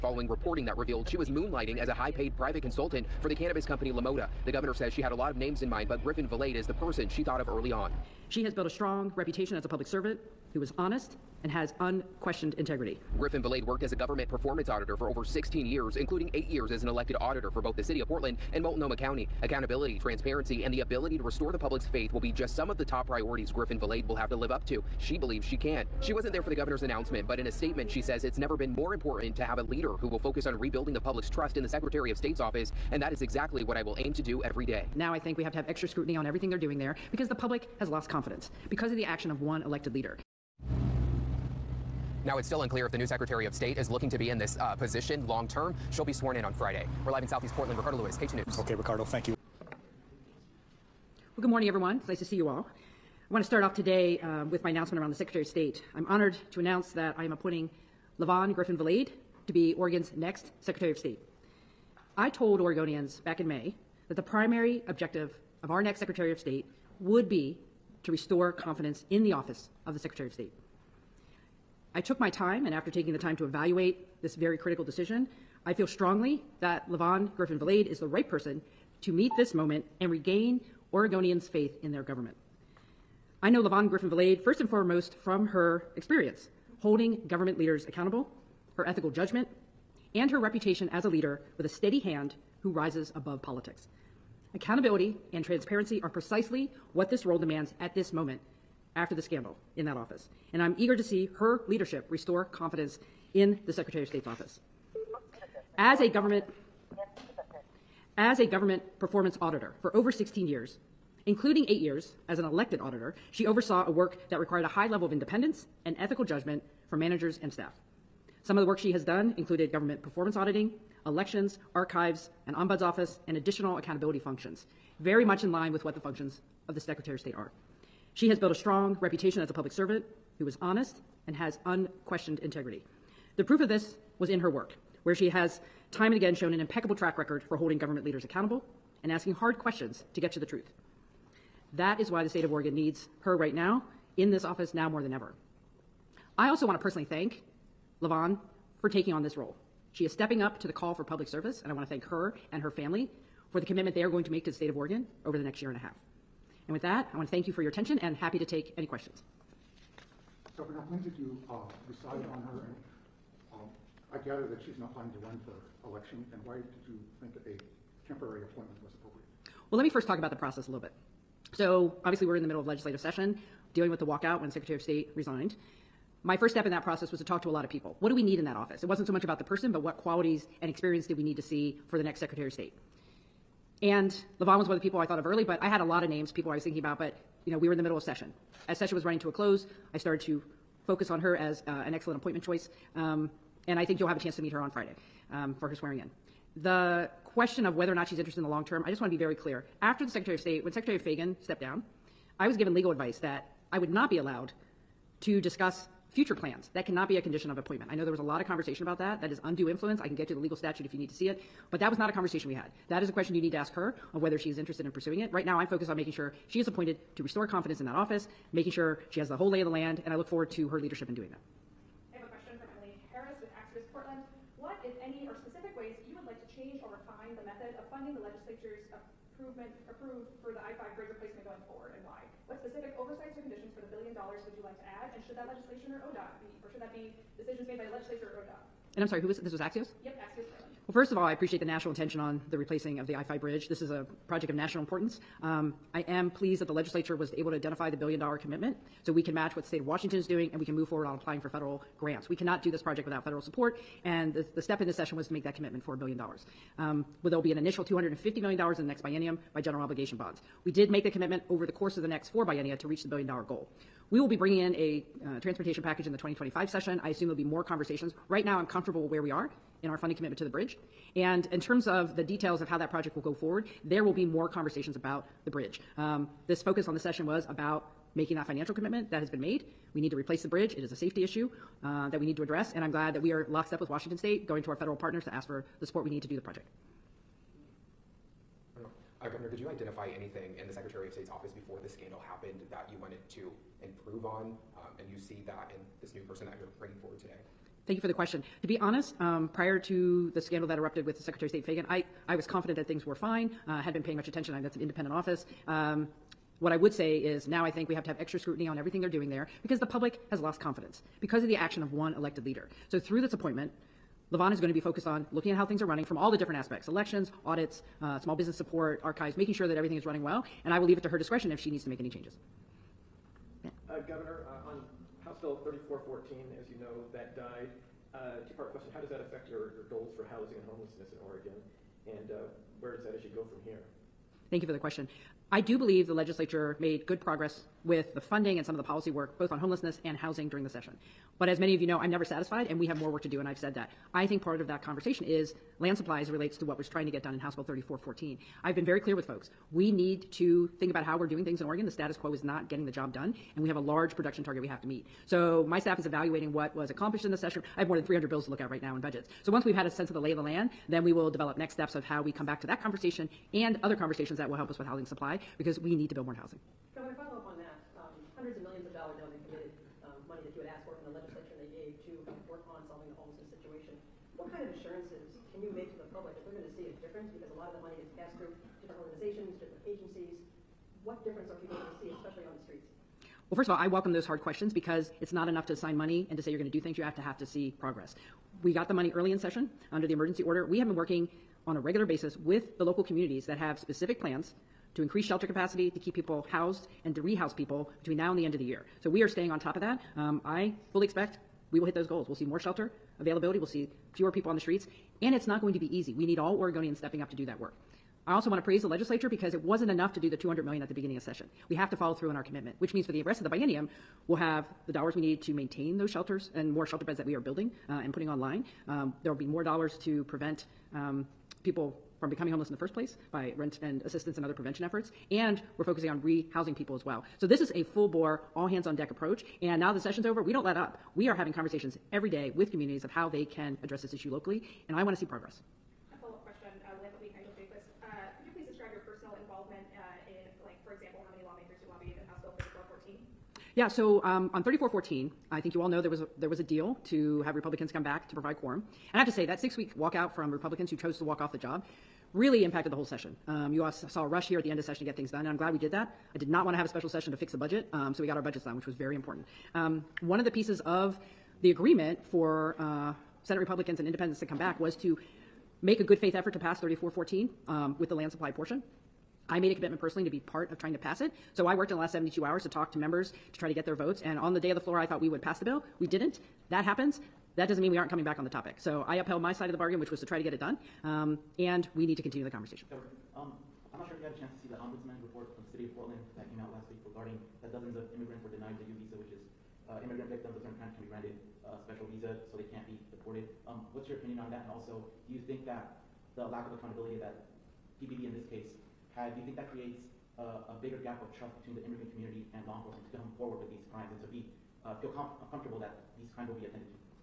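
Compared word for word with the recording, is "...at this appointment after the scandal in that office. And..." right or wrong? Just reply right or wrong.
wrong.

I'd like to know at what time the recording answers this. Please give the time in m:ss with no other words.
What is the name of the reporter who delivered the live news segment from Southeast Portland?
0:47.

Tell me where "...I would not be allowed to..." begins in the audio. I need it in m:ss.
3:23.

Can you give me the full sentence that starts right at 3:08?
As session was running to a close, I started to focus on her as uh, an excellent appointment choice.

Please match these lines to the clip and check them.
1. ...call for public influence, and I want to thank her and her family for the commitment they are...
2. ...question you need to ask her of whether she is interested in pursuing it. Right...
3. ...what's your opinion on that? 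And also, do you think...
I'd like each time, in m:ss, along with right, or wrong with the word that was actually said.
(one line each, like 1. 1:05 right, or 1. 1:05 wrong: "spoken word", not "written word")
1. 2:30 wrong: "service", not "influence"
2. 3:33 right
3. 8:13 right.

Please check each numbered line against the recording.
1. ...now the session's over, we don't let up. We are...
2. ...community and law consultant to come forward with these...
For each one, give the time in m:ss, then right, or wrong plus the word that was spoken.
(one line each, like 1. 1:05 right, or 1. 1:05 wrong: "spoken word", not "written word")
1. 7:09 right
2. 8:22 wrong: "enforcement", not "consultant".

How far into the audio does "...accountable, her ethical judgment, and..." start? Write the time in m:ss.
1:27.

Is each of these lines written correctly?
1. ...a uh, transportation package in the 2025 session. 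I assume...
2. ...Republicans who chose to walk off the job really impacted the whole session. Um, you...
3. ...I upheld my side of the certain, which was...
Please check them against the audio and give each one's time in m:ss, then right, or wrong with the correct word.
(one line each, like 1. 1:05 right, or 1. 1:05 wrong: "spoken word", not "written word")
1. 4:24 right
2. 7:30 right
3. 7:59 wrong: "bargain", not "certain".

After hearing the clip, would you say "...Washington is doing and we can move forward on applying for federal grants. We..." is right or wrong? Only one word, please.
right.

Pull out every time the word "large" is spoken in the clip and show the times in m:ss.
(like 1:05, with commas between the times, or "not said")
5:53.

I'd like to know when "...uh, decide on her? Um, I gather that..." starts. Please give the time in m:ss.
2:41.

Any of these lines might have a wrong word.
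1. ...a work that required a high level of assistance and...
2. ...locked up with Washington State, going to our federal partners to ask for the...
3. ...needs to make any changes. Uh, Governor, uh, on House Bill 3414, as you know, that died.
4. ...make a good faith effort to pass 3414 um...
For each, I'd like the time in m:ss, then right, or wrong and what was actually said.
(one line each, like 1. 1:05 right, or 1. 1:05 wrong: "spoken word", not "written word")
1. 1:53 wrong: "independence", not "assistance"
2. 4:43 right
3. 5:21 right
4. 7:45 right.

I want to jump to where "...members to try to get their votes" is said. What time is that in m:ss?
7:52.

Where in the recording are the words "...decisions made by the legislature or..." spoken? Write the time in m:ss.
3:57.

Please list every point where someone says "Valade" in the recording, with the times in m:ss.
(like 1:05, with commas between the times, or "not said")
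0:06, 0:13, 0:23, 0:58, 1:17, 1:24.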